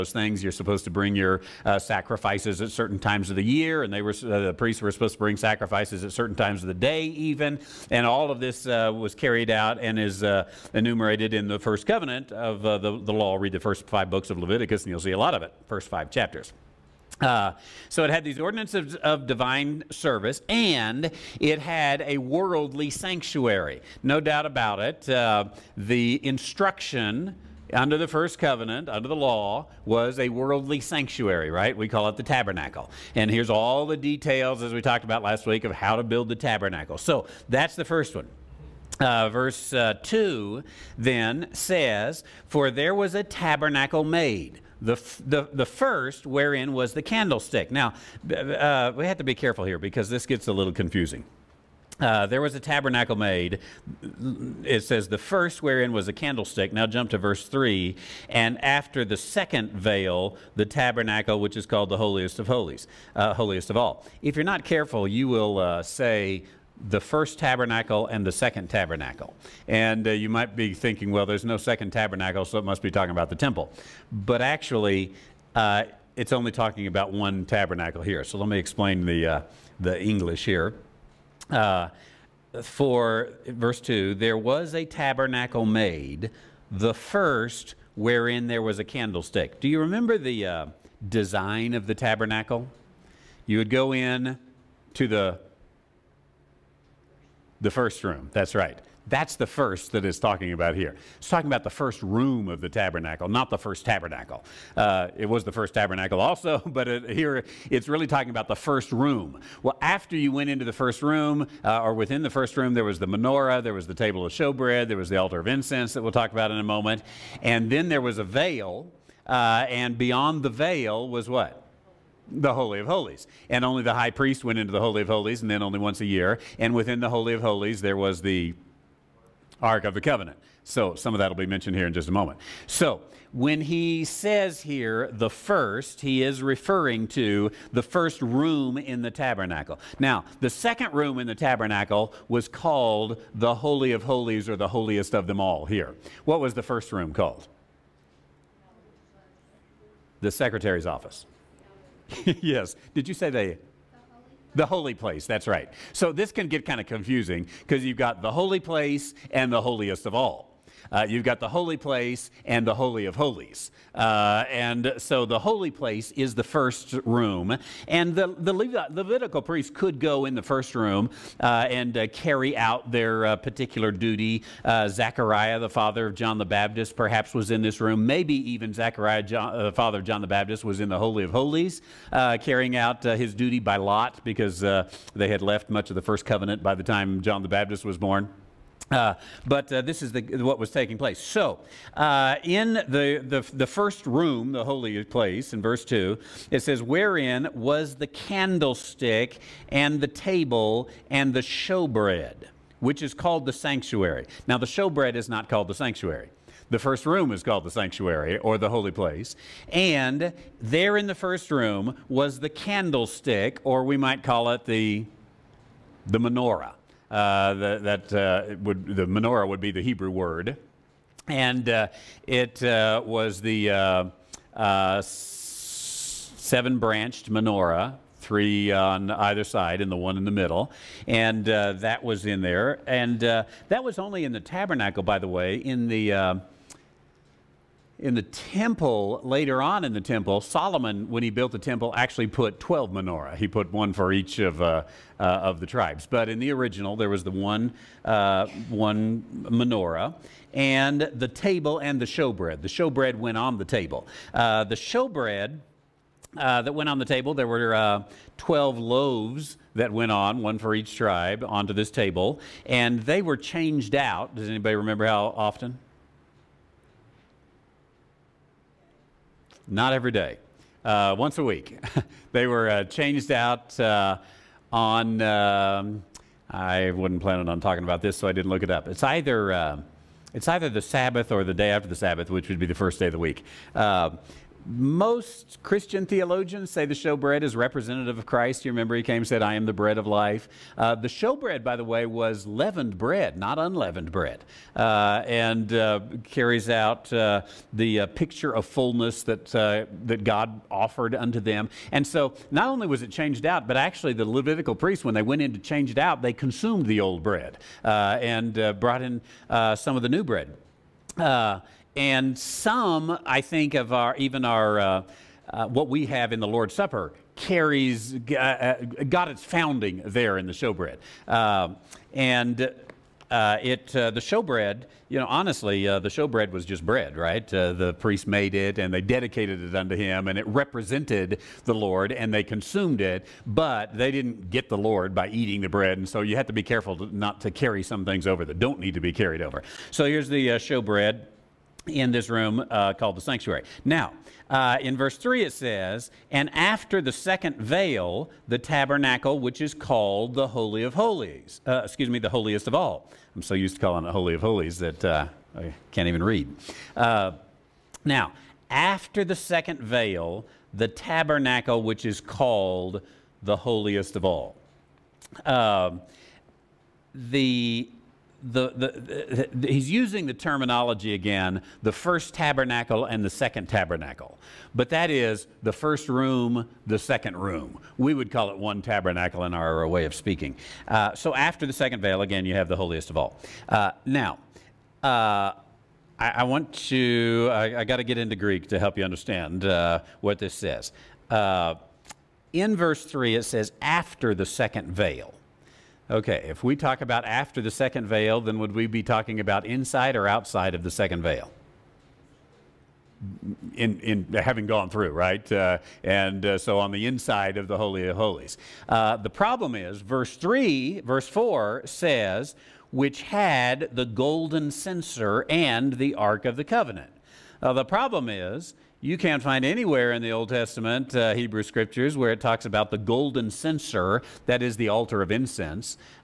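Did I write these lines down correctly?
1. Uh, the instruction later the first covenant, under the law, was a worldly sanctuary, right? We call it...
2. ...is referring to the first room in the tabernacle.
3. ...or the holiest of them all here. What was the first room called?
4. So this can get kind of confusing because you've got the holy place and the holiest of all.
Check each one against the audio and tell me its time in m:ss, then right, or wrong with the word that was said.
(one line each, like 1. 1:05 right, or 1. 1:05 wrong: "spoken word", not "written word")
1. 0:25 wrong: "under", not "later"
2. 2:16 right
3. 2:24 right
4. 2:35 right.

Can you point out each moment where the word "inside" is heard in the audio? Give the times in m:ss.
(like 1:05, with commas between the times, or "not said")
6:39, 6:47.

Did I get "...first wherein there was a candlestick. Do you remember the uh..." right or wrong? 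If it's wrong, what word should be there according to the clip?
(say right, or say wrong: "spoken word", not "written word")
right.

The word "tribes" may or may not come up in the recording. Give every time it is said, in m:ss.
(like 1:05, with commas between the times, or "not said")
4:05, 4:20.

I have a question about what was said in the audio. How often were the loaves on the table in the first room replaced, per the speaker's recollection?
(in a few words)
once a week.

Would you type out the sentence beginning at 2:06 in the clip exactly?
And within the Holy of Holies, there was the Ark of the Covenant.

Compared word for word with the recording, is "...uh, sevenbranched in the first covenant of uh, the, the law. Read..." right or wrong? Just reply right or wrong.
wrong.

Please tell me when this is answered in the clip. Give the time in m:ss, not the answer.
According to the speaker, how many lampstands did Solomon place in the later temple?
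4:02.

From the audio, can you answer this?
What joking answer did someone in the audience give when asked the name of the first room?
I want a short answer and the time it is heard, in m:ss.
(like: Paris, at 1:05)
The secretary's office, at 2:30.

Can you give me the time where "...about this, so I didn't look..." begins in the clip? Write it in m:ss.
4:37.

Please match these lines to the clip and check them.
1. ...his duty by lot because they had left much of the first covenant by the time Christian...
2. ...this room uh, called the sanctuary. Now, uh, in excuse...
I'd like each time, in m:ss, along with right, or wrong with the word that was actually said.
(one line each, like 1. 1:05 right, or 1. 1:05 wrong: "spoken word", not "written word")
1. 3:03 wrong: "John", not "Christian"
2. 5:42 wrong: "verse", not "excuse".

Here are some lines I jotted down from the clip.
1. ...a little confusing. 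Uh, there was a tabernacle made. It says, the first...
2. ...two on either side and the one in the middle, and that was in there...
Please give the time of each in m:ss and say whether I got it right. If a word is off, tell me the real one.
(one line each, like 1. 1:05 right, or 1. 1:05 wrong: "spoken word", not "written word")
1. 0:50 right
2. 3:48 wrong: "three", not "two".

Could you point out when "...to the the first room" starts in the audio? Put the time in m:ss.
1:34.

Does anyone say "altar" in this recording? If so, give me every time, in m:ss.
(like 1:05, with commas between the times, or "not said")
1:55, 7:04.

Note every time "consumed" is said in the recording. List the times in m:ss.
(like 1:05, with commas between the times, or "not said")
5:06, 5:32.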